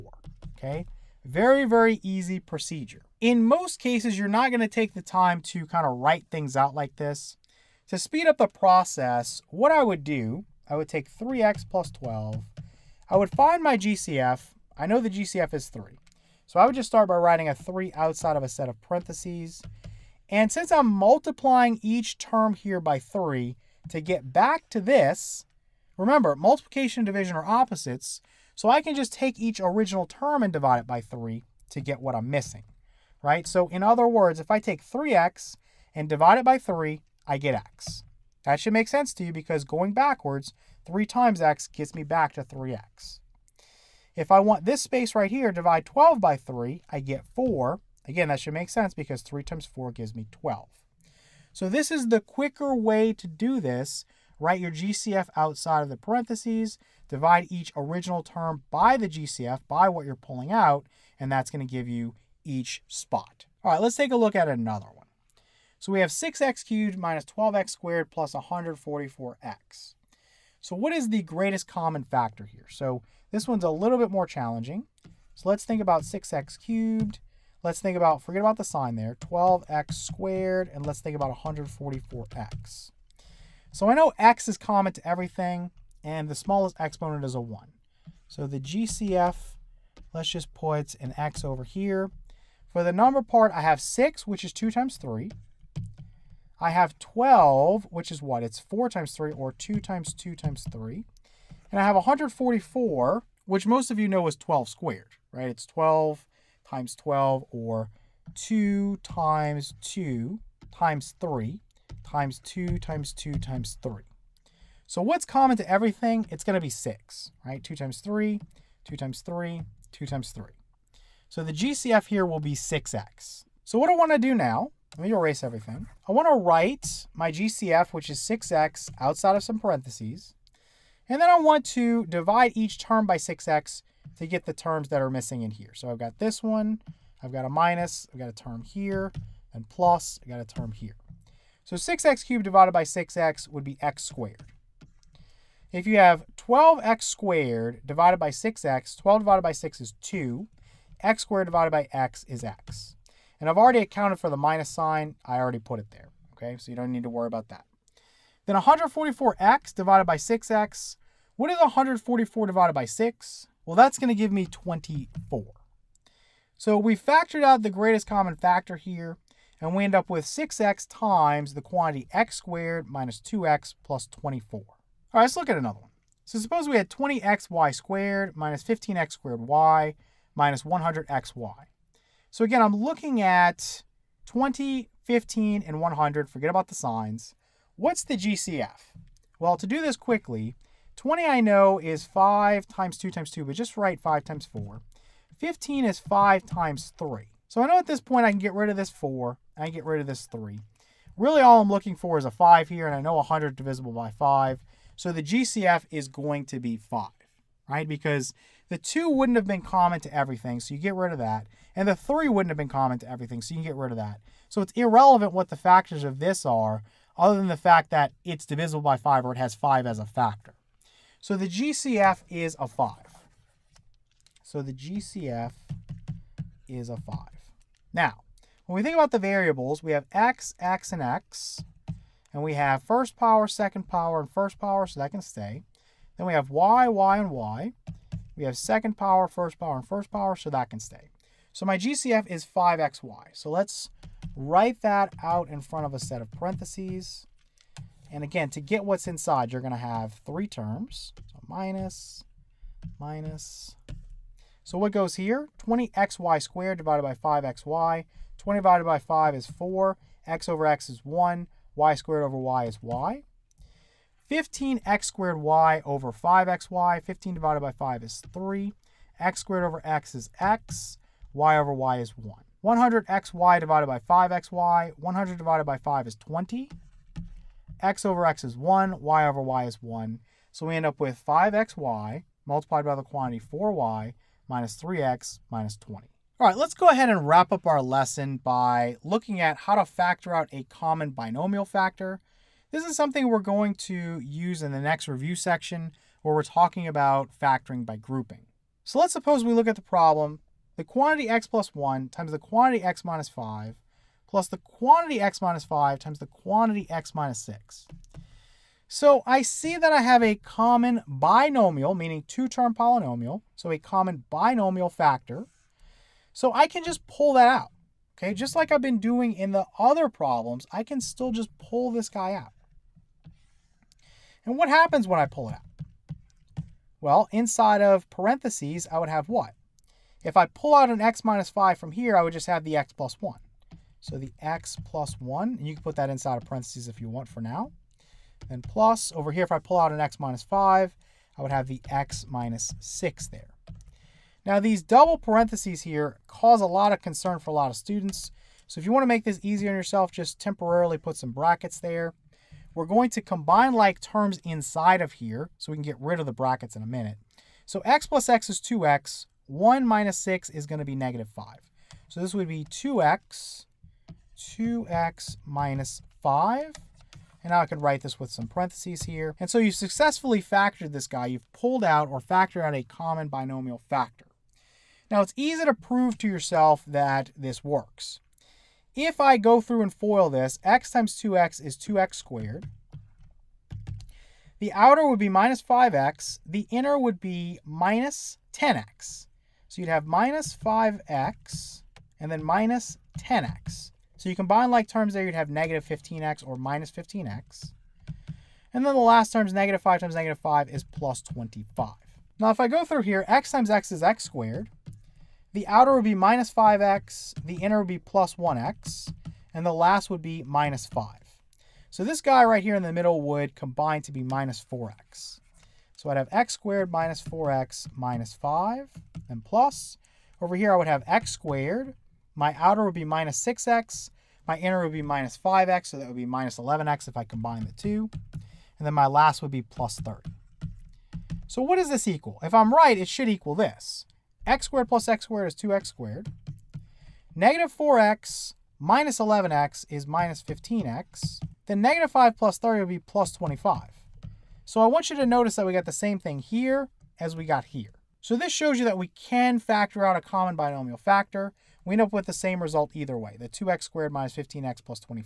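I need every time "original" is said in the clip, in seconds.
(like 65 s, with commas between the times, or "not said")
29 s, 57 s.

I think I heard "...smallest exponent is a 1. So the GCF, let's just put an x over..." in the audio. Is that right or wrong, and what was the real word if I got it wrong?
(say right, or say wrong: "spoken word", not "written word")
right.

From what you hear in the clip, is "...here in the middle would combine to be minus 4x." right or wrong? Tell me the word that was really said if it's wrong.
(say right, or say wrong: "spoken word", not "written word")
right.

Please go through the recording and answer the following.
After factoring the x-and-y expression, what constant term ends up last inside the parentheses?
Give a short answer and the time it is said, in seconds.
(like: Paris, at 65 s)
-20, at 285 s.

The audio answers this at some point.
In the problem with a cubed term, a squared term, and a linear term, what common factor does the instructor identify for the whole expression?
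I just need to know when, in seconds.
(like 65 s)
121 s.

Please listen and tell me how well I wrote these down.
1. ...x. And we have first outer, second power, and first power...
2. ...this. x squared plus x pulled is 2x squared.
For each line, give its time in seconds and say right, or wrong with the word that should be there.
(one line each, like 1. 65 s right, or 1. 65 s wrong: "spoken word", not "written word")
1. 231 s wrong: "power", not "outer"
2. 433 s wrong: "squared", not "pulled".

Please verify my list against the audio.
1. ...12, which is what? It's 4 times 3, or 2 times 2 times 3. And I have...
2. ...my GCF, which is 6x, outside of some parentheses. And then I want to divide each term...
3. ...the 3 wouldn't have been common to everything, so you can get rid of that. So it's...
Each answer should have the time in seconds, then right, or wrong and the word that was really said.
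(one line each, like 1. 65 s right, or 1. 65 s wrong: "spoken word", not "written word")
1. 96 s right
2. 127 s right
3. 211 s right.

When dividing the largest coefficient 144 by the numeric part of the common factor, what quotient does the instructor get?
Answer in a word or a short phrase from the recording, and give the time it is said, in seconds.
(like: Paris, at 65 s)
24, at 163 s.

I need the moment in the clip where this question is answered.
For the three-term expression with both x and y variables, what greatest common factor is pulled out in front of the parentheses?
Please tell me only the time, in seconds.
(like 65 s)
241 s.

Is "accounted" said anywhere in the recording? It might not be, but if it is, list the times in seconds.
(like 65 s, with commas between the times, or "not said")
153 s.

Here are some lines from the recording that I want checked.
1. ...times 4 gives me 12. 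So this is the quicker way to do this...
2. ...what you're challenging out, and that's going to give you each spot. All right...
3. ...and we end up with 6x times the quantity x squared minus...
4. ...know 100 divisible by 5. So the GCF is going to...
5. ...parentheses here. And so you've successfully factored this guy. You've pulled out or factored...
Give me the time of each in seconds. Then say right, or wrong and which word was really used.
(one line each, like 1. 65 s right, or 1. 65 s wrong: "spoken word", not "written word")
1. 49 s right
2. 59 s wrong: "pulling", not "challenging"
3. 169 s right
4. 202 s right
5. 368 s right.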